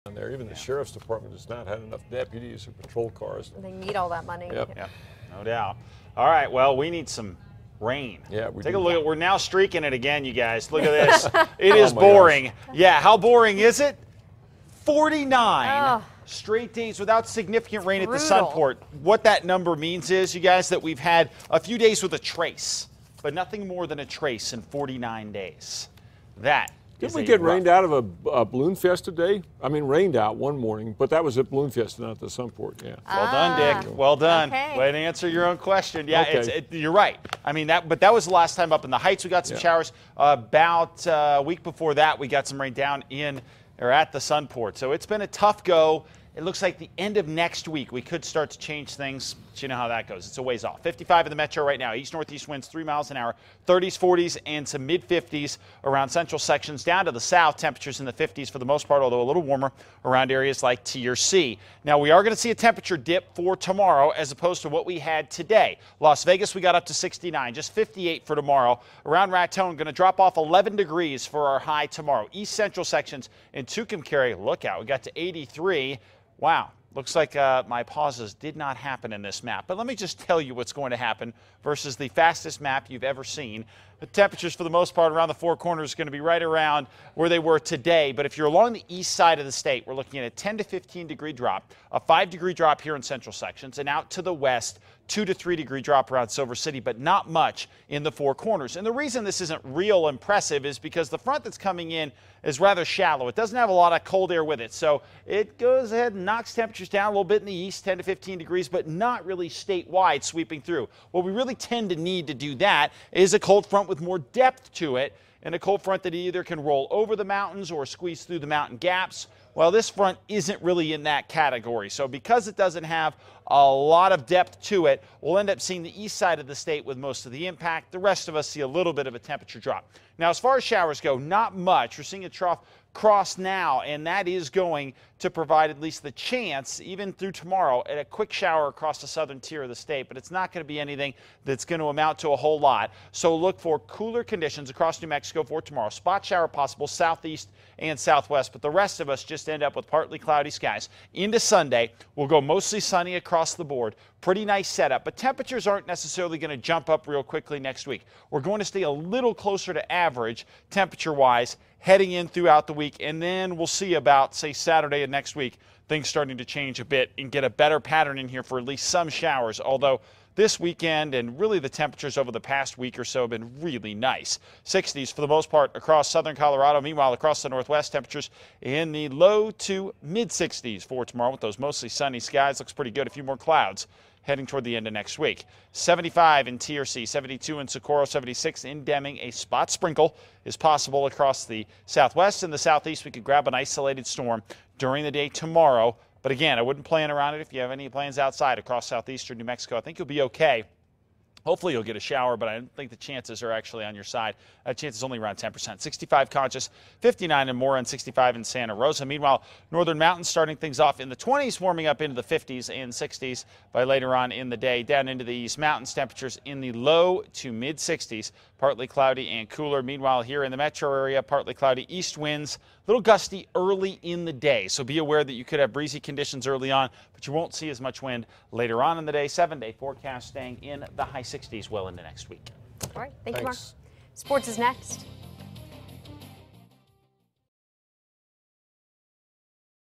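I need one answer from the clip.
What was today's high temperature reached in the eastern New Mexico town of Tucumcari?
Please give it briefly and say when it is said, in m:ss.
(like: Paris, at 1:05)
83, at 1:15.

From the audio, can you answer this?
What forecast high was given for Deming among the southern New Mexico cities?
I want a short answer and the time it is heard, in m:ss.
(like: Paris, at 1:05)
76, at 3:08.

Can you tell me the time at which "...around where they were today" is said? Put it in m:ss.
1:26.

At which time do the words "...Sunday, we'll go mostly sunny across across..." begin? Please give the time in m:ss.
2:31.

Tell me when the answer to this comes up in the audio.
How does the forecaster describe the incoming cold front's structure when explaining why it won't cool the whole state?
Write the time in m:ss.
1:42.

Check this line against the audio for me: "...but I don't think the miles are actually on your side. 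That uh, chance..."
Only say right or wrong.
wrong.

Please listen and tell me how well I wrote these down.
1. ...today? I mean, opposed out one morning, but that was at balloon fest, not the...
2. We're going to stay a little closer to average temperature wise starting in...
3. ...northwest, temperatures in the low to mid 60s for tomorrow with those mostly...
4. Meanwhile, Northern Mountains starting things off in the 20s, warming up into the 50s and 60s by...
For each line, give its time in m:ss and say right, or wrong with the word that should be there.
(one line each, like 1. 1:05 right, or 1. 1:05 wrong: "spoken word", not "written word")
1. 0:29 wrong: "rained", not "opposed"
2. 2:38 wrong: "heading", not "starting"
3. 2:57 right
4. 3:29 right.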